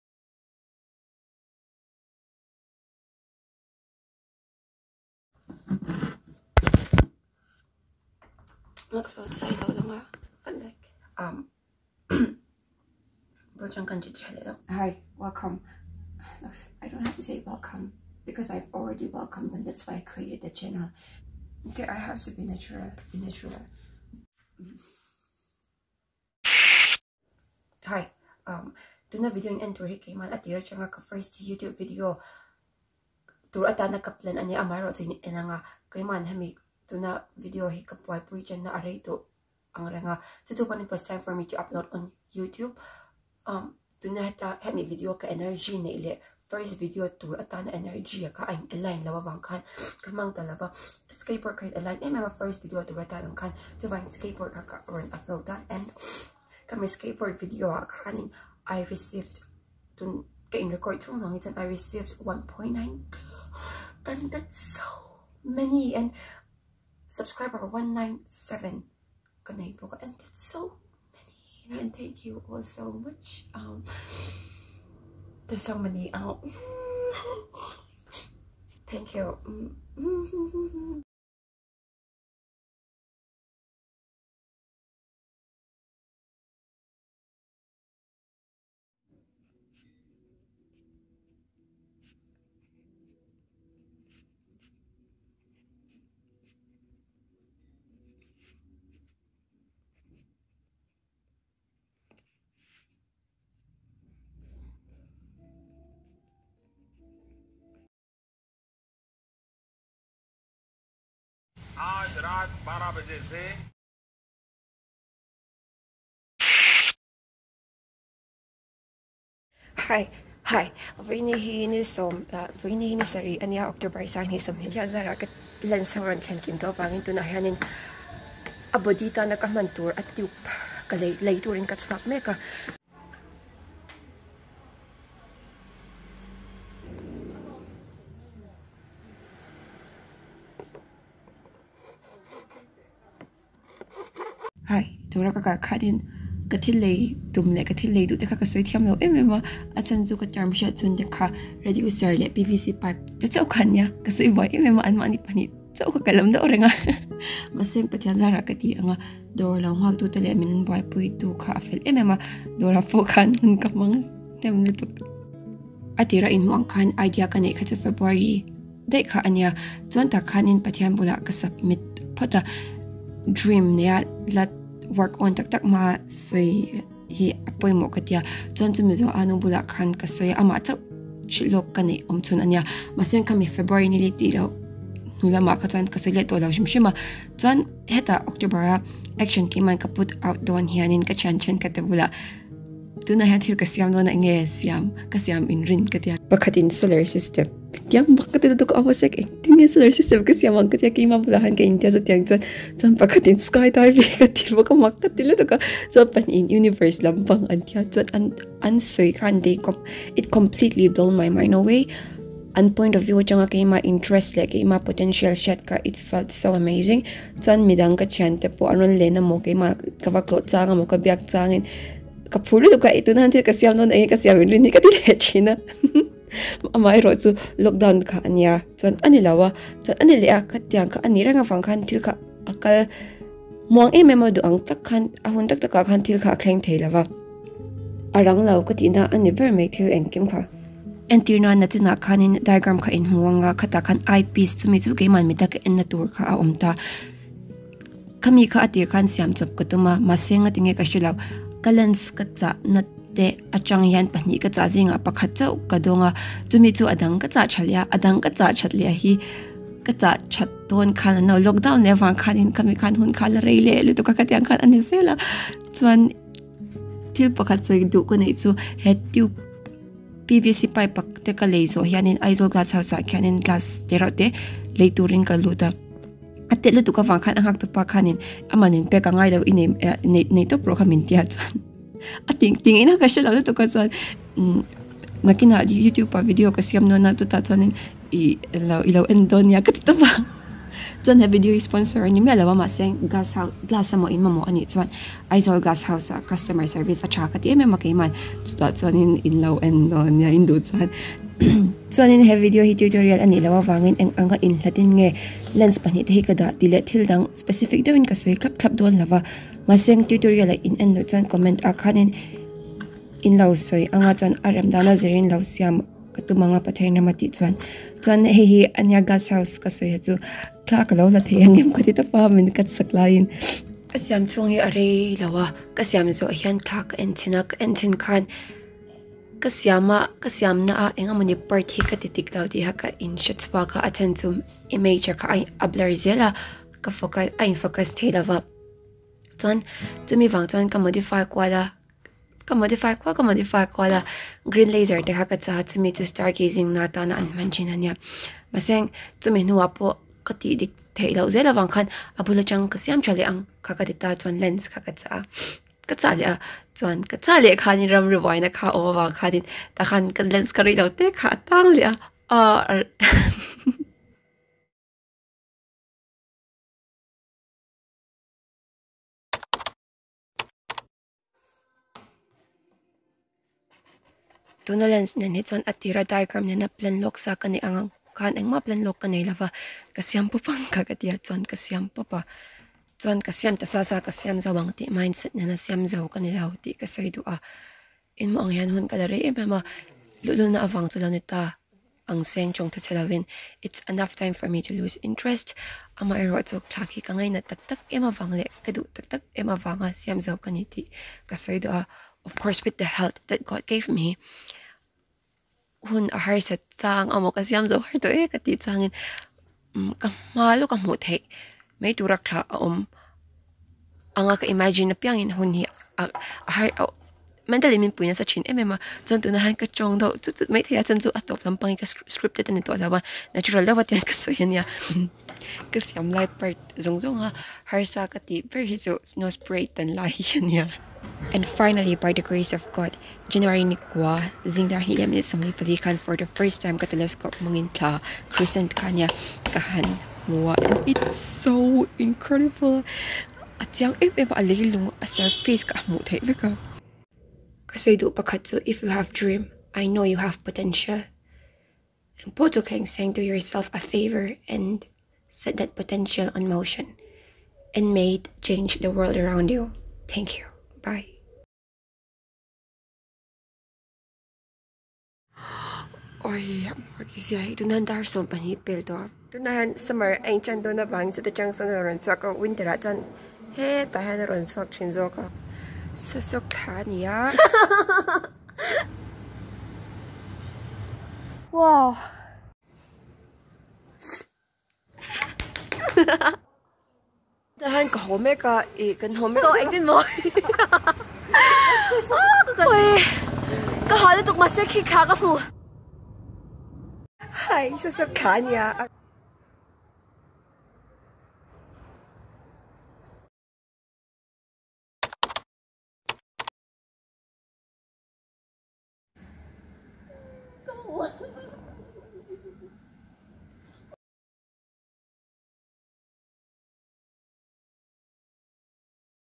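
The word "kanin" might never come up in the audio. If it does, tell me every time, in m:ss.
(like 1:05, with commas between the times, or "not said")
0:57.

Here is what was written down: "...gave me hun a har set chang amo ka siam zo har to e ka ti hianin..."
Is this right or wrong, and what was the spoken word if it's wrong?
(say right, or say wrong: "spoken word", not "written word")
wrong: "changin", not "hianin".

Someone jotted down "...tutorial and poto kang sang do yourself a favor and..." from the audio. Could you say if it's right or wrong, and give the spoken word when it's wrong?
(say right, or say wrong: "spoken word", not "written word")
wrong: "potential", not "tutorial".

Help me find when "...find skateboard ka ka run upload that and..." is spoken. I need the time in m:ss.
0:53.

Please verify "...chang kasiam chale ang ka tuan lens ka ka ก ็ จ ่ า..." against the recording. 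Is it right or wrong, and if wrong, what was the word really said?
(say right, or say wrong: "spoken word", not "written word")
right.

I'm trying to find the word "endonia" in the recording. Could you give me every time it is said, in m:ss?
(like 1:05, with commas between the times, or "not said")
4:49, 4:59.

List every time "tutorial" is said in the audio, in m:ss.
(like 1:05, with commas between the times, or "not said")
5:02, 5:10.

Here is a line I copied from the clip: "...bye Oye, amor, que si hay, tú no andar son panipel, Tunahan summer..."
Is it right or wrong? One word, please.
right.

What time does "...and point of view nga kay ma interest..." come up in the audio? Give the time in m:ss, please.
3:32.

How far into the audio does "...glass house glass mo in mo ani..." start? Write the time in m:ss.
4:53.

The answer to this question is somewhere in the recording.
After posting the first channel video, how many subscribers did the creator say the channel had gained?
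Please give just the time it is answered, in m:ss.
1:07.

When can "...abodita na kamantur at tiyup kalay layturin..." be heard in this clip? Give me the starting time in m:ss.
2:08.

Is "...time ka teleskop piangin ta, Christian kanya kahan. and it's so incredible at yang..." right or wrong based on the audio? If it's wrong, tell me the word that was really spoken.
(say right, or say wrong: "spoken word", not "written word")
wrong: "mungin", not "piangin".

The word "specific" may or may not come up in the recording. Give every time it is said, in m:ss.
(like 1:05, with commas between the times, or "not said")
5:07.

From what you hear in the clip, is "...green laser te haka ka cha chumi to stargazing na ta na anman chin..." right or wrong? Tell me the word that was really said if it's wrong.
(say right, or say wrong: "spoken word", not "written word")
right.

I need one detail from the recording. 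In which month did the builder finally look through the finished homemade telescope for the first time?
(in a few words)
January.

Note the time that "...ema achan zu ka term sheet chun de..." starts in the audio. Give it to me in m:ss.
2:29.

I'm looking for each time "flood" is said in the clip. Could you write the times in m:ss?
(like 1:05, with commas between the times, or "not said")
not said.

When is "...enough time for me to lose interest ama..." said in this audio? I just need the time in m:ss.
6:33.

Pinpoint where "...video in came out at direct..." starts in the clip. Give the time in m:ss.
0:29.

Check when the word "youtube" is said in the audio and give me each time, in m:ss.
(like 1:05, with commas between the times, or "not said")
0:31, 0:42, 4:45.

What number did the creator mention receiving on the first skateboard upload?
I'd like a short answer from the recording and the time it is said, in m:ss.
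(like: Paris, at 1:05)
1.9, at 1:02.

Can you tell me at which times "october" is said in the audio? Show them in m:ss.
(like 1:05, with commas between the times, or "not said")
2:03, 3:08.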